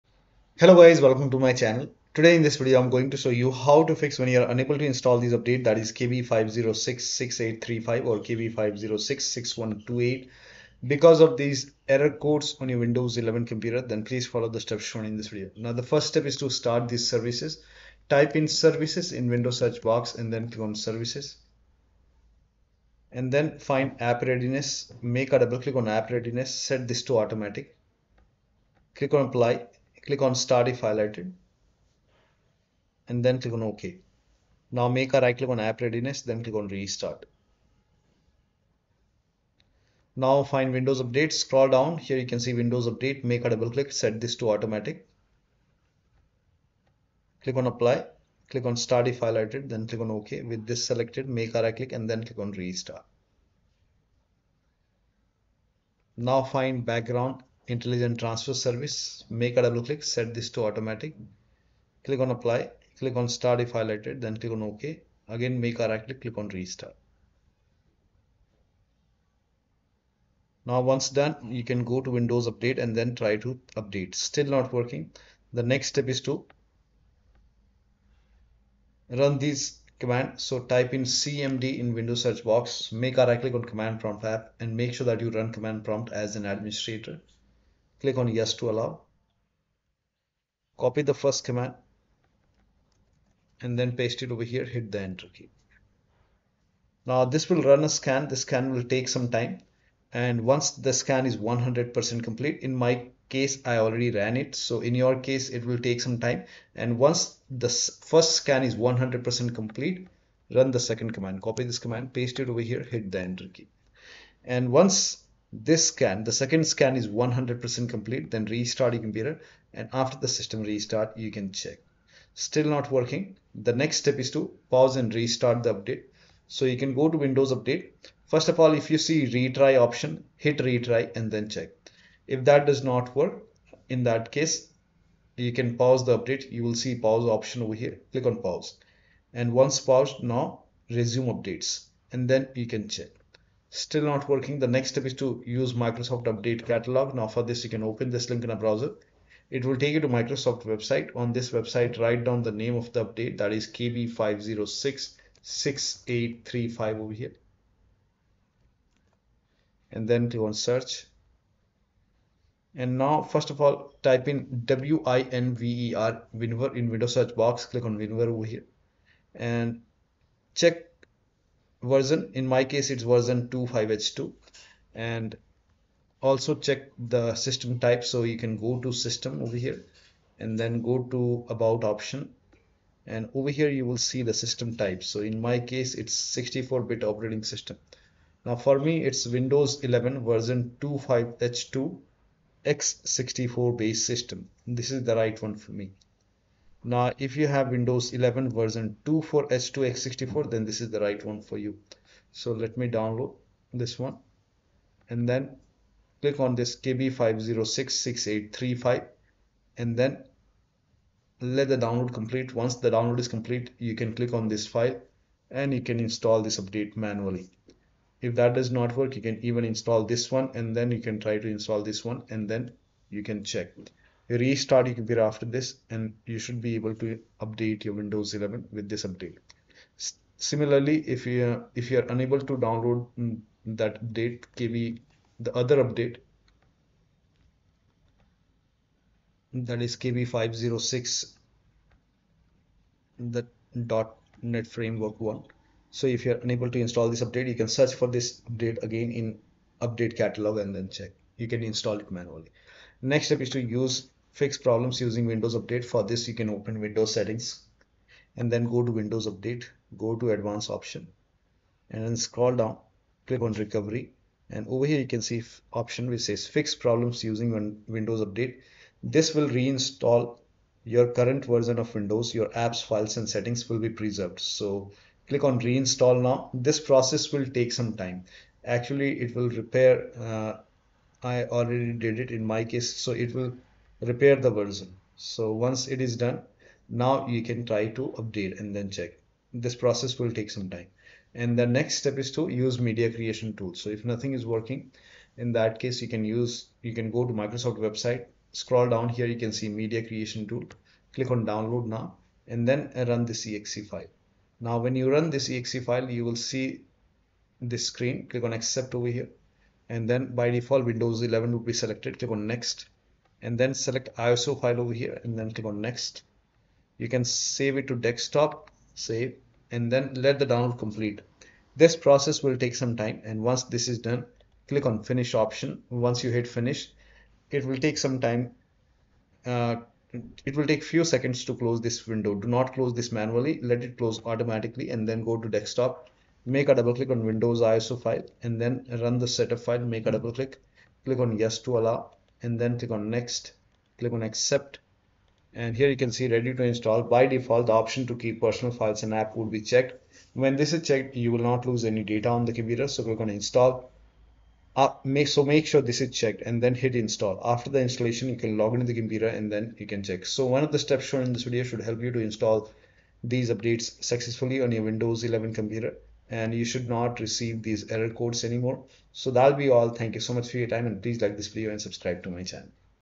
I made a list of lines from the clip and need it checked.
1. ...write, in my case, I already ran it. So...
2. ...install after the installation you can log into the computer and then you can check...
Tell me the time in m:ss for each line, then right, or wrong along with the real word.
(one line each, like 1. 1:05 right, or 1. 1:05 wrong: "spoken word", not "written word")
1. 1:42 wrong: "complete", not "write"
2. 5:56 right.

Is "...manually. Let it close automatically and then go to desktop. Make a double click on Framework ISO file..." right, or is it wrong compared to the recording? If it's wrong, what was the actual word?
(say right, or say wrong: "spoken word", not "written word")
wrong: "Windows", not "Framework".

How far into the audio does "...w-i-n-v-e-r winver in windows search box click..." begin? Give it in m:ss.
2:44.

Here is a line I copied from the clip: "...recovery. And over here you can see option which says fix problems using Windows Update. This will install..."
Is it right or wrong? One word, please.
wrong.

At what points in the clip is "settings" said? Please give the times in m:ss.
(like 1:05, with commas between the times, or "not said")
4:17, 4:33.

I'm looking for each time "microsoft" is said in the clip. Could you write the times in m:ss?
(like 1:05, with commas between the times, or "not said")
2:25, 2:30, 4:57.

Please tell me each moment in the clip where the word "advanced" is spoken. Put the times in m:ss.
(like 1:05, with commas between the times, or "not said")
4:20.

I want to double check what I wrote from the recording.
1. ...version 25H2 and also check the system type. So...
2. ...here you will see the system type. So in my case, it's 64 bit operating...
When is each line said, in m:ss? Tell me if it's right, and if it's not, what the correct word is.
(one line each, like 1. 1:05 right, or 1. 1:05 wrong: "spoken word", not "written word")
1. 2:53 right
2. 3:03 right.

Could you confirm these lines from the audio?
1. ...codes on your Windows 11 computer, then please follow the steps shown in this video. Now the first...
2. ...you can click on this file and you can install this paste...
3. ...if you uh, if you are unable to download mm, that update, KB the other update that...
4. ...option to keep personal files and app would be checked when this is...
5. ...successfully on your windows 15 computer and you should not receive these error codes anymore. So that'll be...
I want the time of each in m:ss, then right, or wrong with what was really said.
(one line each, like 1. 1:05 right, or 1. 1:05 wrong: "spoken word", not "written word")
1. 0:12 right
2. 3:33 wrong: "update", not "paste"
3. 3:51 right
4. 5:47 right
5. 6:04 wrong: "11", not "15".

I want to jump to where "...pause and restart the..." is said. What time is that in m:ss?
2:04.